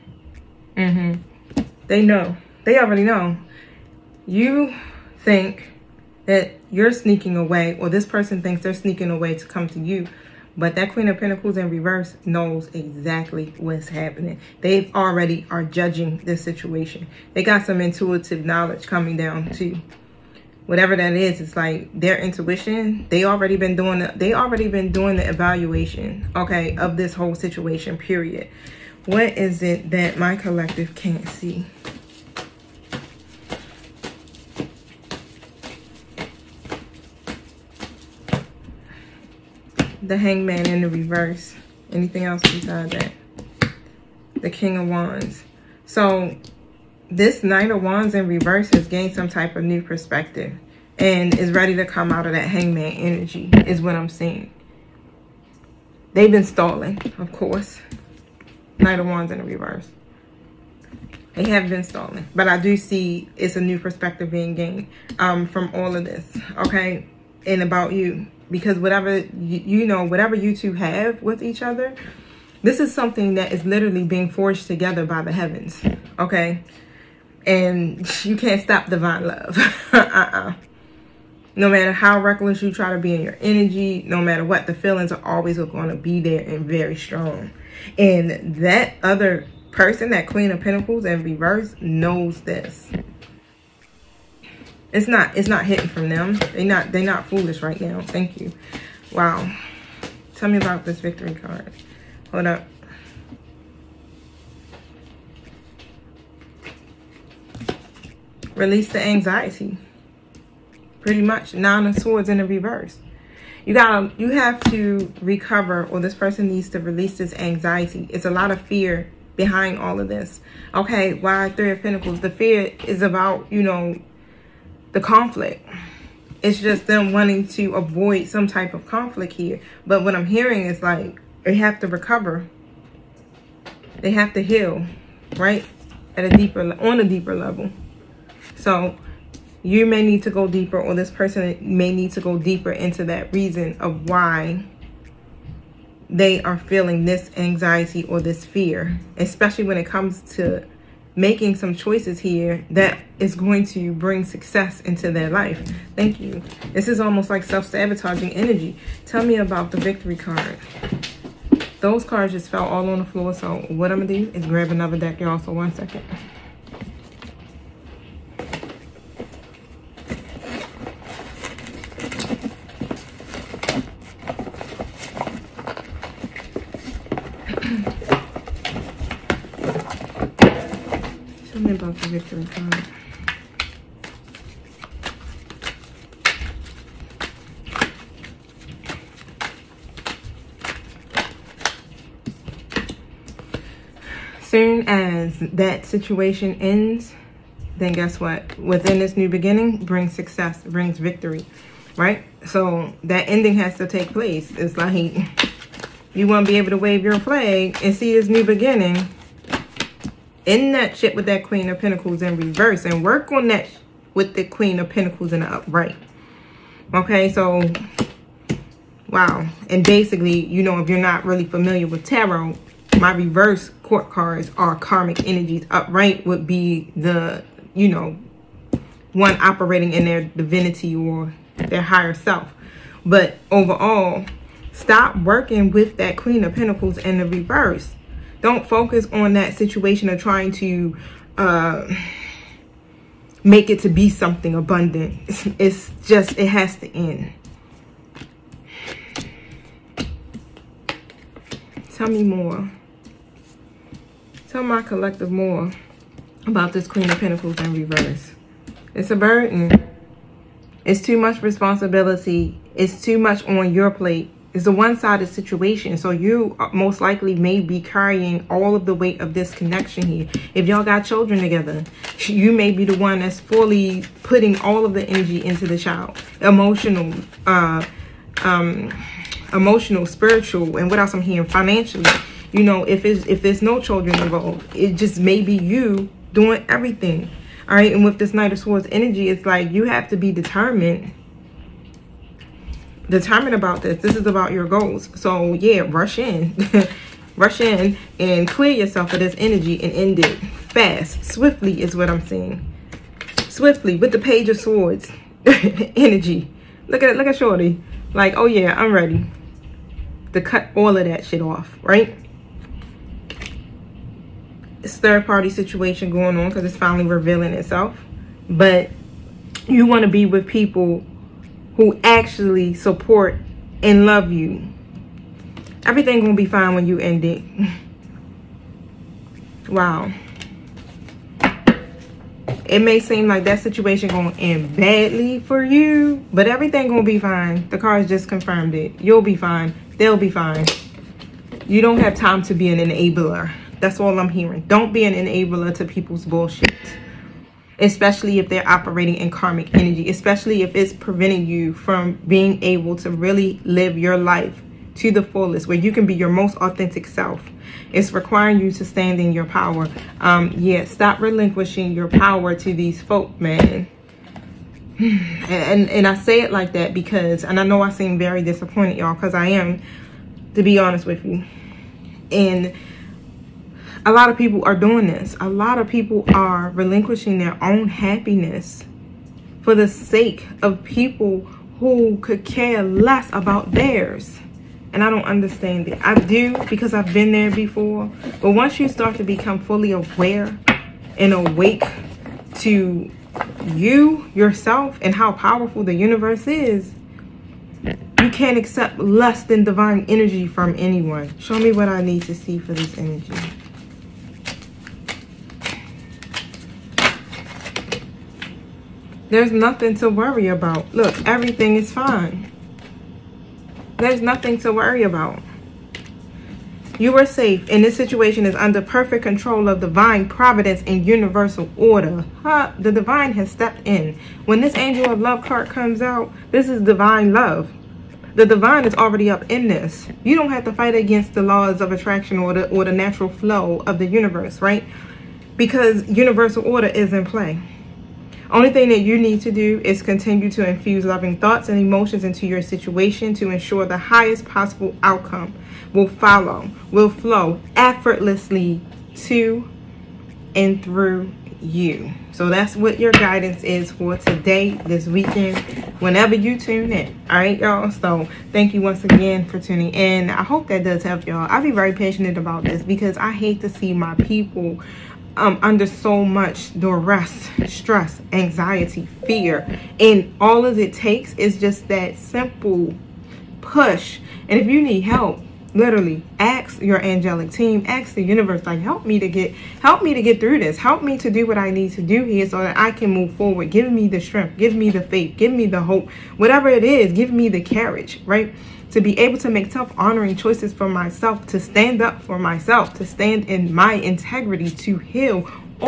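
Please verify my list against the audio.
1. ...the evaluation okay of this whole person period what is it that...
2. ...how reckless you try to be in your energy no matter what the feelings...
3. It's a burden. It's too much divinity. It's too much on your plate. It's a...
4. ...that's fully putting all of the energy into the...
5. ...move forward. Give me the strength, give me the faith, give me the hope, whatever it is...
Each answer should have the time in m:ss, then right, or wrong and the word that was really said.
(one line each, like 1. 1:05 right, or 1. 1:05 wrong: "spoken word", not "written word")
1. 0:25 wrong: "situation", not "person"
2. 1:21 right
3. 4:18 wrong: "responsibility", not "divinity"
4. 4:33 right
5. 8:03 right.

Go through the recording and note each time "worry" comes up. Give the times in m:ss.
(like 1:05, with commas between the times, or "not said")
6:50, 6:54.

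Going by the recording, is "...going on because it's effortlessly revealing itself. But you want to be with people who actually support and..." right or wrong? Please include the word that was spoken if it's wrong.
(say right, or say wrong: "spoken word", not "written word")
wrong: "finally", not "effortlessly".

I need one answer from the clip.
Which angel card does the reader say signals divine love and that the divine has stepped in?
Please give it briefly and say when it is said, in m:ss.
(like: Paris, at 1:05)
Angel of Love, at 7:04.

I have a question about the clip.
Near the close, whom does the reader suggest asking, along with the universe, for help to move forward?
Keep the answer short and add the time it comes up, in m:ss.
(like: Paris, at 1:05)
Your angelic team, at 7:56.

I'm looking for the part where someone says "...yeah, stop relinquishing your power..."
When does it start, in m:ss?
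6:00.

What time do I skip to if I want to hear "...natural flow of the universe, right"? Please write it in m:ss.
7:12.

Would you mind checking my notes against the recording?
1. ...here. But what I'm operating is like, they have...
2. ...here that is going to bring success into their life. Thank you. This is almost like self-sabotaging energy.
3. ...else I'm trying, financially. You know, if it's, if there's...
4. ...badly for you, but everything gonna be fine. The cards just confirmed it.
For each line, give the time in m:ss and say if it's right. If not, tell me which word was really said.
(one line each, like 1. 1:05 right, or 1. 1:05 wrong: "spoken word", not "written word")
1. 2:09 wrong: "hearing", not "operating"
2. 2:32 right
3. 4:40 wrong: "hearing", not "trying"
4. 5:34 right.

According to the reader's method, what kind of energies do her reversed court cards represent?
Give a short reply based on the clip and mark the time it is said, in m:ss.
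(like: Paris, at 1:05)
Karmic energies, at 3:44.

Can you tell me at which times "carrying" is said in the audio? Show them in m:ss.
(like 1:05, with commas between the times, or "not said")
4:27.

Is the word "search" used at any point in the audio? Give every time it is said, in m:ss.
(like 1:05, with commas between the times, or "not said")
not said.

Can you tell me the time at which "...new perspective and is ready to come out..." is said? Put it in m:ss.
0:49.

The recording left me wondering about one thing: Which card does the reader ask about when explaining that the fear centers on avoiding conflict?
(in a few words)
Three of Pentacles.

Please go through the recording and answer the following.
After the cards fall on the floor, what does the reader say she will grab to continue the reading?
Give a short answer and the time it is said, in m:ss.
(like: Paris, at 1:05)
Another deck, at 2:44.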